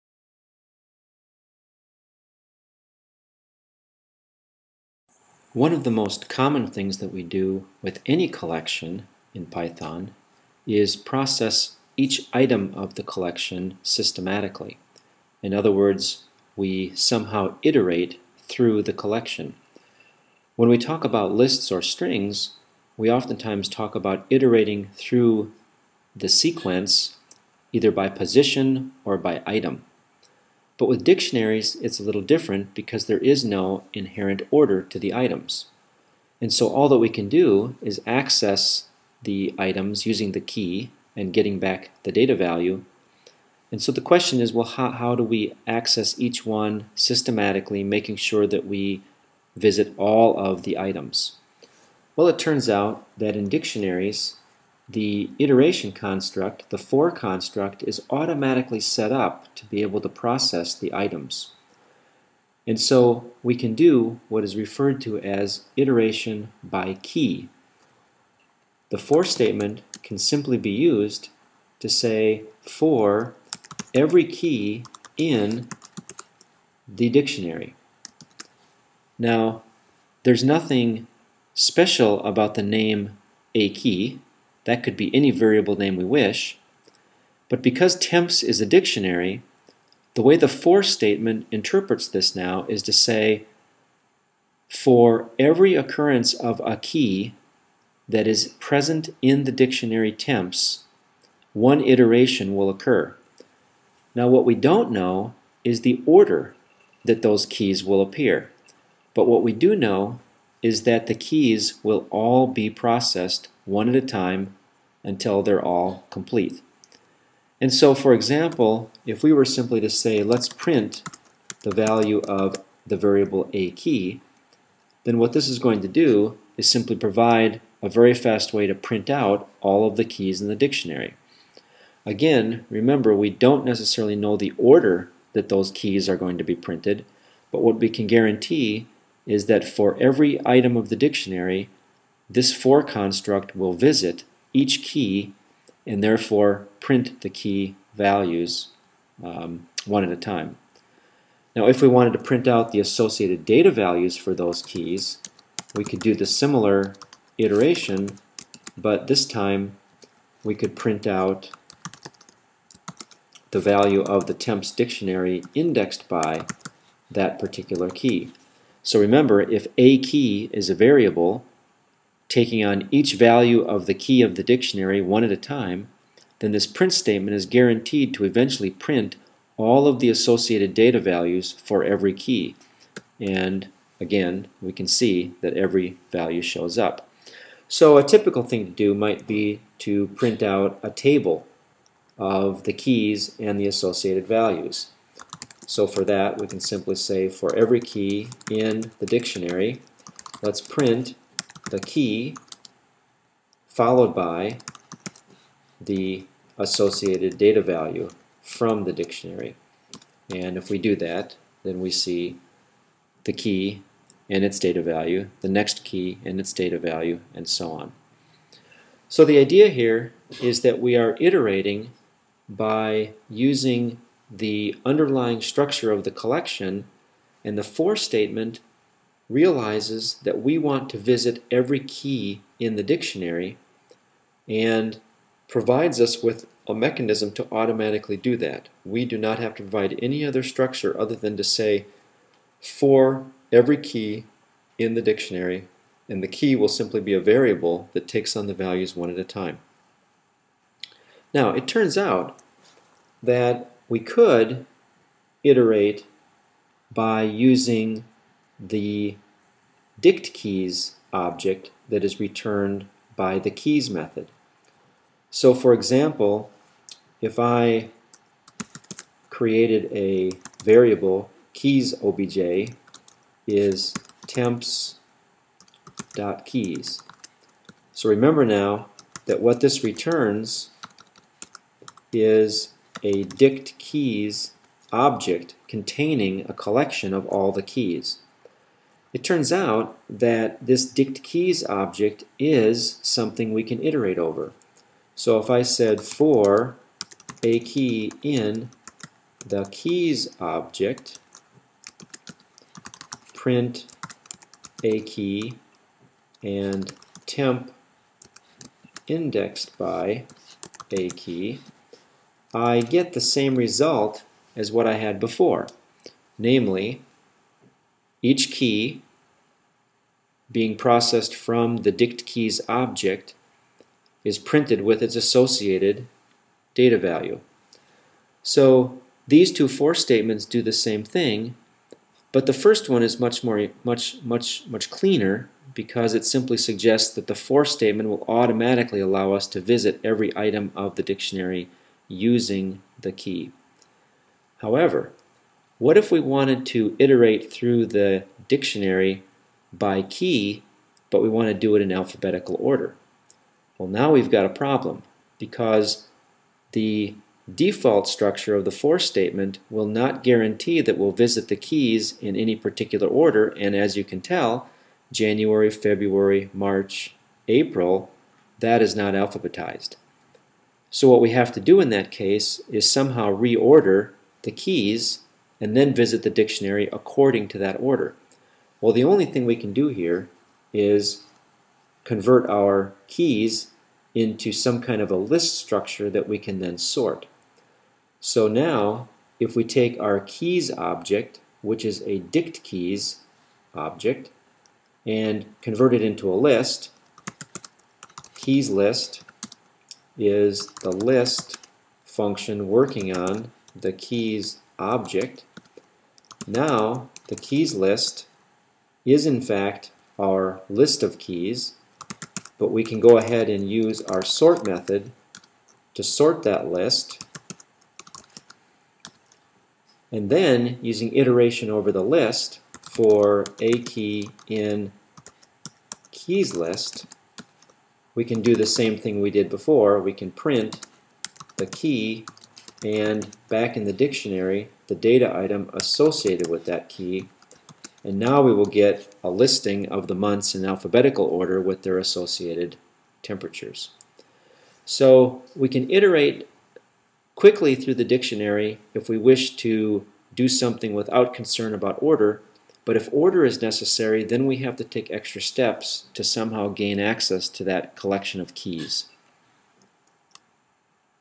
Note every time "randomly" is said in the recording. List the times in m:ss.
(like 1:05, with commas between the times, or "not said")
not said.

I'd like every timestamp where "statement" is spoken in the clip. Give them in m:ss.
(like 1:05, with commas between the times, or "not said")
1:09, 1:30, 2:56, 3:47, 5:29, 5:37, 5:58.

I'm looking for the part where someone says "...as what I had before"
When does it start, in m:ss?
5:14.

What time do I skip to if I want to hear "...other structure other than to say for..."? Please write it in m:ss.
4:00.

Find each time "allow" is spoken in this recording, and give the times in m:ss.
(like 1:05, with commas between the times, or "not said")
5:38.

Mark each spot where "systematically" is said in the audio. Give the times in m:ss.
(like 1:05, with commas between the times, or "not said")
0:13, 0:46.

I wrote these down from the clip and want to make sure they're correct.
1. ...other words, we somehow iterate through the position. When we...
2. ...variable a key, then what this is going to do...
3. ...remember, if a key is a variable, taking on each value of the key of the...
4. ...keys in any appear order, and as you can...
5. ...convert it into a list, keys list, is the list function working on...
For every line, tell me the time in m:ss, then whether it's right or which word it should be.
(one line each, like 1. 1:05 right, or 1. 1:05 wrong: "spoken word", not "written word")
1. 0:15 wrong: "collection", not "position"
2. 2:02 right
3. 2:48 right
4. 6:01 wrong: "particular", not "appear"
5. 6:35 right.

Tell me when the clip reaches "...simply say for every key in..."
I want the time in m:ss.
3:16.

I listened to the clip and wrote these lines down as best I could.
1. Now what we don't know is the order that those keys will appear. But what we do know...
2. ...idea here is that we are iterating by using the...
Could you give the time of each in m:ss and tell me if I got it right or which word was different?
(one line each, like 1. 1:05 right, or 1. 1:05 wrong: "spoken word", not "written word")
1. 1:44 right
2. 3:39 right.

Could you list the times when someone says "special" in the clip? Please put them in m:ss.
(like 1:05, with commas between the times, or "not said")
1:21.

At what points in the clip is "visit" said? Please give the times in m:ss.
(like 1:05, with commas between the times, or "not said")
0:49, 2:23, 3:50, 5:39, 6:01, 6:15.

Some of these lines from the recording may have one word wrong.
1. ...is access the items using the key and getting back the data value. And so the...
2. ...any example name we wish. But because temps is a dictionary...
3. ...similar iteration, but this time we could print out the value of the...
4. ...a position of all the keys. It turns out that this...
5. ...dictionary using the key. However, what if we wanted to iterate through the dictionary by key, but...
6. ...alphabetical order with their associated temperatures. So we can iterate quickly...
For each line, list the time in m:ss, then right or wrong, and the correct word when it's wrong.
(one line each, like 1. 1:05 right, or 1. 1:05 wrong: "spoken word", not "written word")
1. 0:37 right
2. 1:25 wrong: "variable", not "example"
3. 2:36 right
4. 4:46 wrong: "collection", not "position"
5. 5:41 right
6. 7:20 right.